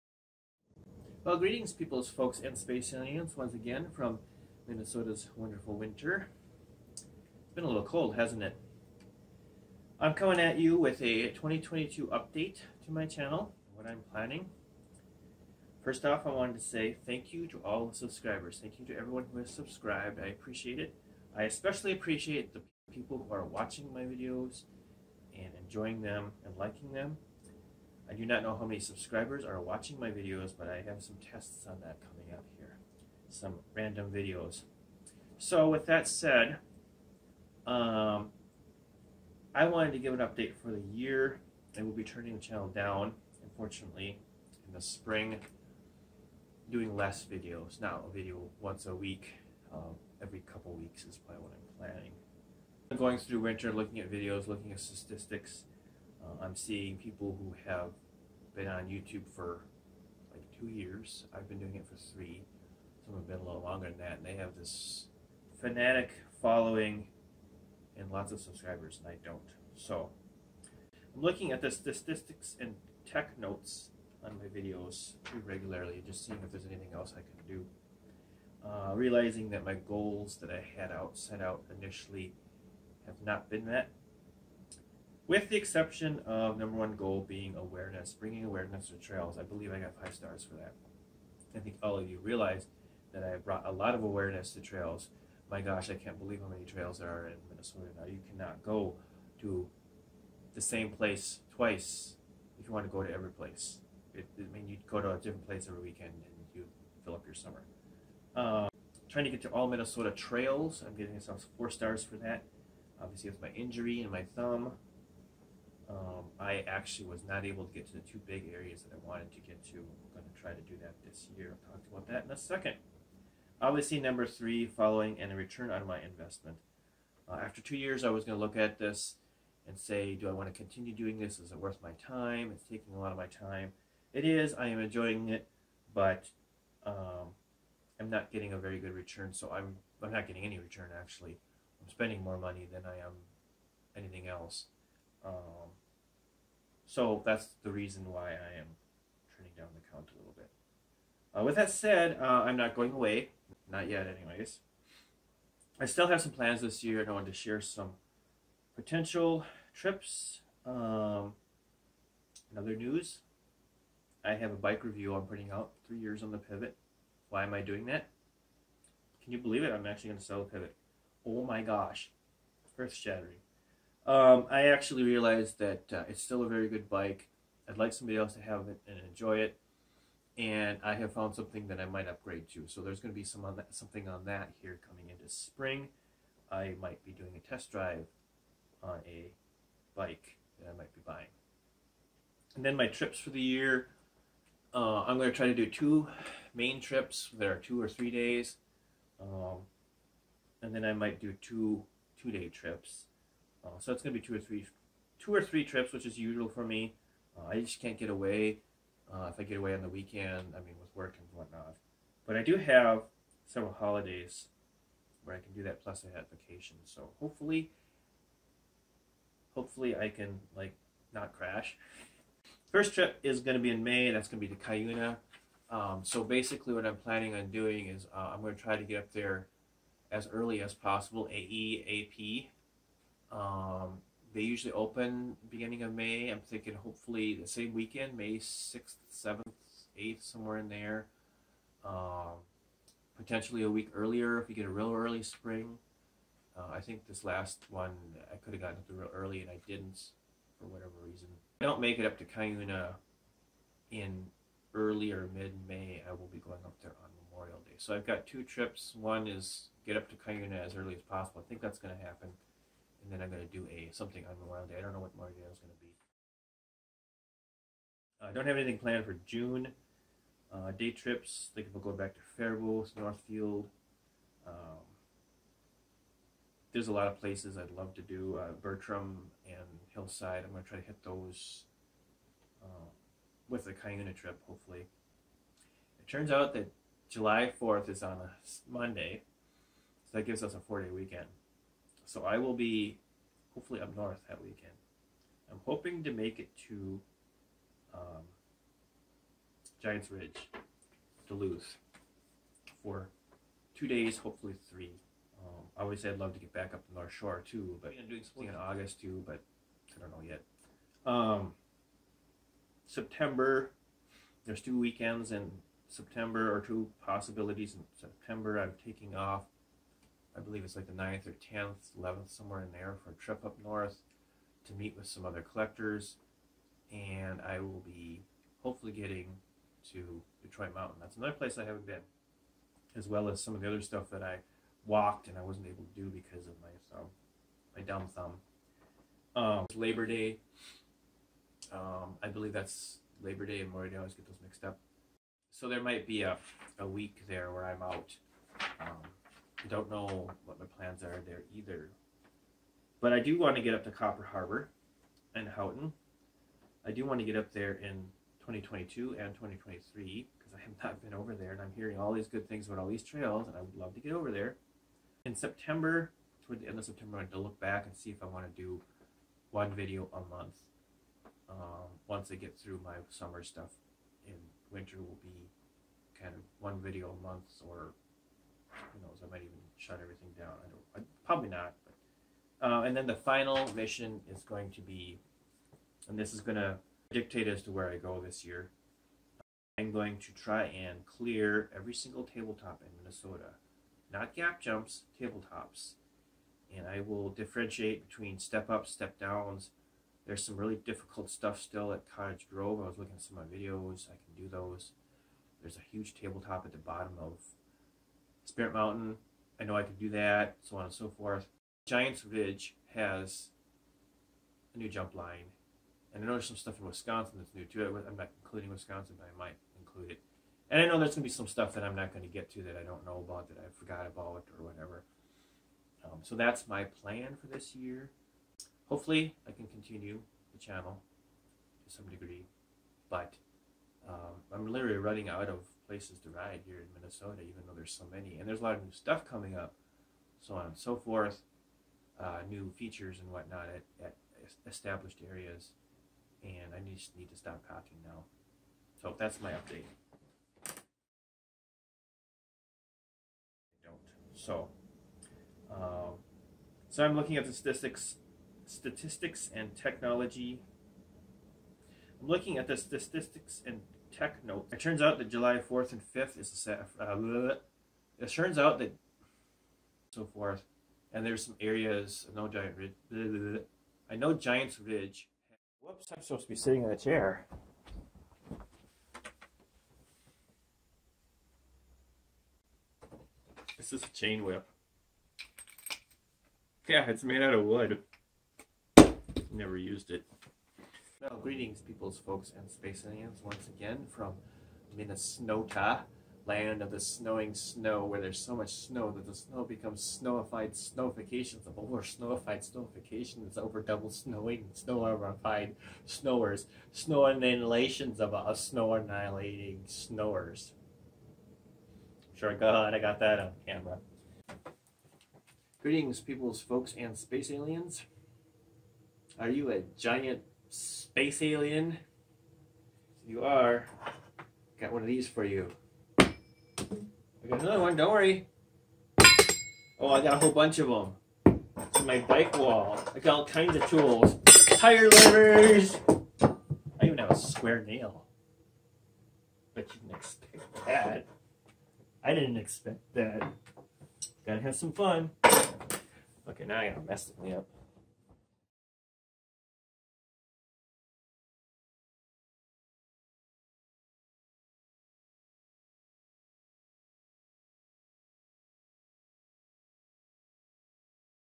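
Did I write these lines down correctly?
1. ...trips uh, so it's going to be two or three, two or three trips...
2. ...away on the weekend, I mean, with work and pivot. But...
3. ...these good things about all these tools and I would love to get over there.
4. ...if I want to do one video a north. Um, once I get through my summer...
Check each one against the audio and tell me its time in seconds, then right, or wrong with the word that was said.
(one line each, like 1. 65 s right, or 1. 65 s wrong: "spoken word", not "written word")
1. 202 s right
2. 209 s wrong: "whatnot", not "pivot"
3. 362 s wrong: "trails", not "tools"
4. 368 s wrong: "month", not "north".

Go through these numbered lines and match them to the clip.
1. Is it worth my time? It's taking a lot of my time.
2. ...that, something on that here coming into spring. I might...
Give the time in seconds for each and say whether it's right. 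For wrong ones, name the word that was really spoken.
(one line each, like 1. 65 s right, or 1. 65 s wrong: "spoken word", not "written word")
1. 131 s right
2. 183 s right.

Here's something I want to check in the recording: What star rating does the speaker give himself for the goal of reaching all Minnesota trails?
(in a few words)
4 stars.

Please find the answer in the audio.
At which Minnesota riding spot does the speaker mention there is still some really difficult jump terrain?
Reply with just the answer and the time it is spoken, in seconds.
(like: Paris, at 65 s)
Cottage Grove, at 402 s.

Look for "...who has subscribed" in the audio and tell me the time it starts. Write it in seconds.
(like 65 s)
19 s.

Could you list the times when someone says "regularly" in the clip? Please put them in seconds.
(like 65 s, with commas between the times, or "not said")
75 s.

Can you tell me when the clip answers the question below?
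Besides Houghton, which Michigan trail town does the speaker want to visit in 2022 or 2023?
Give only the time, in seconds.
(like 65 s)
353 s.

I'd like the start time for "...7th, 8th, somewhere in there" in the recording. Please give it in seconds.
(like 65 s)
239 s.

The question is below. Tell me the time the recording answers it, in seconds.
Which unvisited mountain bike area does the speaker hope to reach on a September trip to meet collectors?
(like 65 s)
330 s.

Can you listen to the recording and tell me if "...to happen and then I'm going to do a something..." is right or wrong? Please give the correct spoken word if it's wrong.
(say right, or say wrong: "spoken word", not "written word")
right.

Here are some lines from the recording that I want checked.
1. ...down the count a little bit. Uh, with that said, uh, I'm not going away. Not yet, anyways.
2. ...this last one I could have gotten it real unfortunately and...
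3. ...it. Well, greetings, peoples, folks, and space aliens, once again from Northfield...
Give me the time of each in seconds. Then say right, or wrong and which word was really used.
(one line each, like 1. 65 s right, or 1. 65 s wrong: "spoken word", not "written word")
1. 149 s right
2. 247 s wrong: "early", not "unfortunately"
3. 490 s wrong: "Minnesota", not "Northfield".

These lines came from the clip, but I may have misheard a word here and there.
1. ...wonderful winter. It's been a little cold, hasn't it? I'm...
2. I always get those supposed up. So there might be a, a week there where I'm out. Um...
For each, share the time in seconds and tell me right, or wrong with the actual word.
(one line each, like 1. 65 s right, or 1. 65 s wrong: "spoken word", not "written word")
1. 5 s right
2. 343 s wrong: "mixed", not "supposed".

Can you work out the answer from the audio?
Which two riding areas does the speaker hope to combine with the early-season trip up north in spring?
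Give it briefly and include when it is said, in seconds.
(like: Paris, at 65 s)
Bertram and Hillside, at 278 s.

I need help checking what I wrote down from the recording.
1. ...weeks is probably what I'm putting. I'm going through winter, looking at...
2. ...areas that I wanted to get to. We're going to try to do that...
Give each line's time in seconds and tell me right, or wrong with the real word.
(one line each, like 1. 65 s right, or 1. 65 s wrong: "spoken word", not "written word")
1. 50 s wrong: "planning", not "putting"
2. 118 s right.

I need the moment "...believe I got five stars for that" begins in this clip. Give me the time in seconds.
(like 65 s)
89 s.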